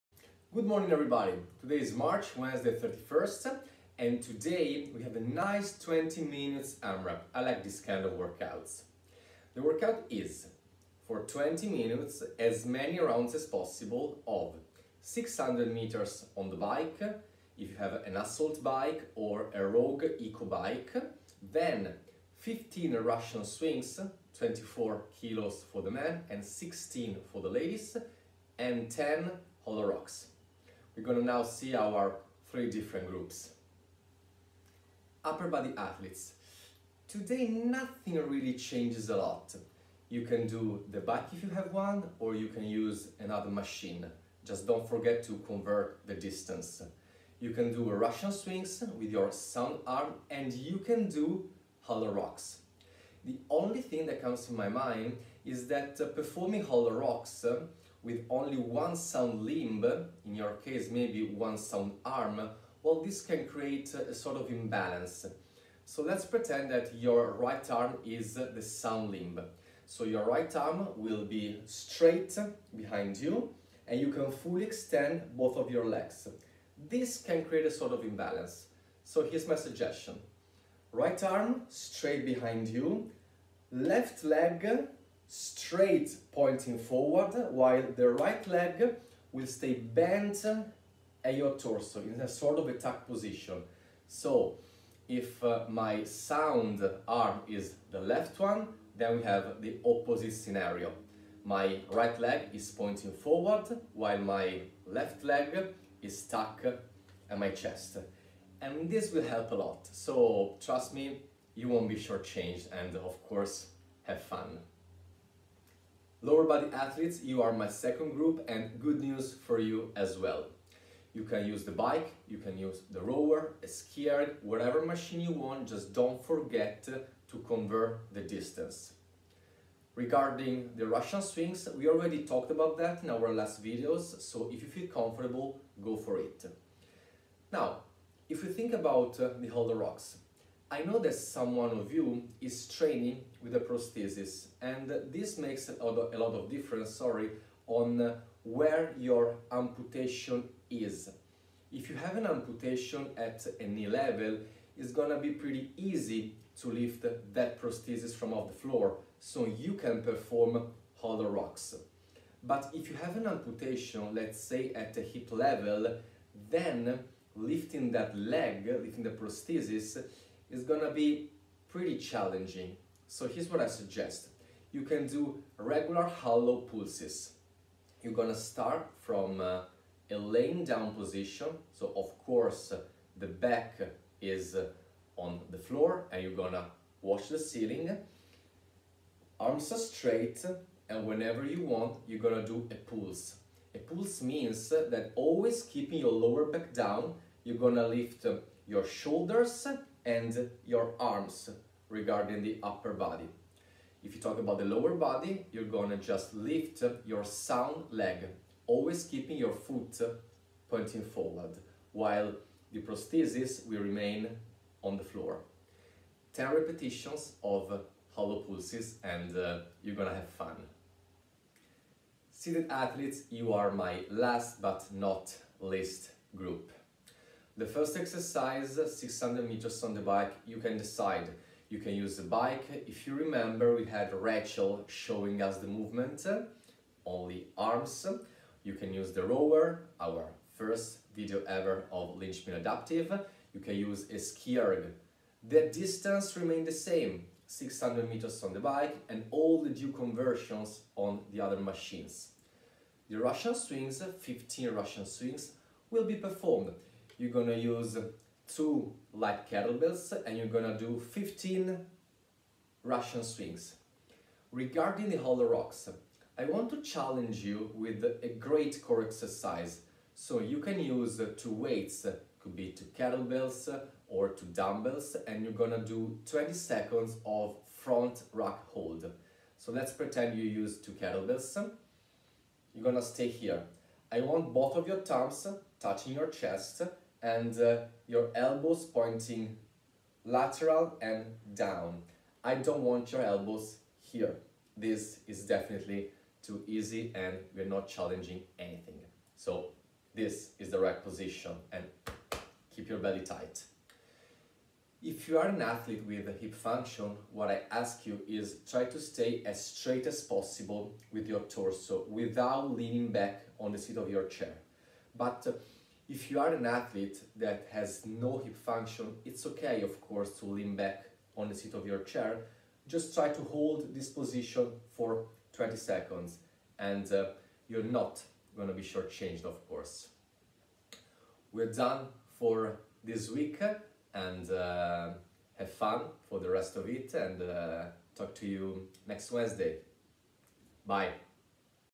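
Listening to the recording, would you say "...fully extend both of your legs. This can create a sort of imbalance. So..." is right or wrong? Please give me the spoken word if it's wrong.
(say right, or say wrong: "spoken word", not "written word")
right.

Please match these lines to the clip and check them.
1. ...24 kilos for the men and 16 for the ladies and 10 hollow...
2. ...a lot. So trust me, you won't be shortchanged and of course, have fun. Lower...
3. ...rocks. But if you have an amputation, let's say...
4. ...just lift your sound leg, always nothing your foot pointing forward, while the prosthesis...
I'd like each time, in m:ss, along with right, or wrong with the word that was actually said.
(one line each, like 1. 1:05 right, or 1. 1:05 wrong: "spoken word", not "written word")
1. 0:24 right
2. 1:49 right
3. 2:41 right
4. 3:25 wrong: "keeping", not "nothing".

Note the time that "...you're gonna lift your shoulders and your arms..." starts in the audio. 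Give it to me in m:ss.
3:17.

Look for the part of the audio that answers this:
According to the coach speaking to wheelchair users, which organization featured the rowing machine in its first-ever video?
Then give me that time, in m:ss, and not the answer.
4:02.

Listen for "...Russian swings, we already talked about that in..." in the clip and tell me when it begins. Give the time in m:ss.
2:10.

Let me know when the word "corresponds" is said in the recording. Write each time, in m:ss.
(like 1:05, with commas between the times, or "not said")
not said.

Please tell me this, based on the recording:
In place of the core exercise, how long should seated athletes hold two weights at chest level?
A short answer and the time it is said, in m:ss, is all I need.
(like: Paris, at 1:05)
20 seconds, at 4:36.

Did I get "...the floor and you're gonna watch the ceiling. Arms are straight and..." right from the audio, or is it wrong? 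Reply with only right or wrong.
right.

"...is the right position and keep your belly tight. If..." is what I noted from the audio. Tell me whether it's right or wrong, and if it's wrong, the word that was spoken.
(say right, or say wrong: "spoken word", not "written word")
right.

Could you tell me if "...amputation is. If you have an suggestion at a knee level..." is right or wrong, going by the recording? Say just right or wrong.
wrong.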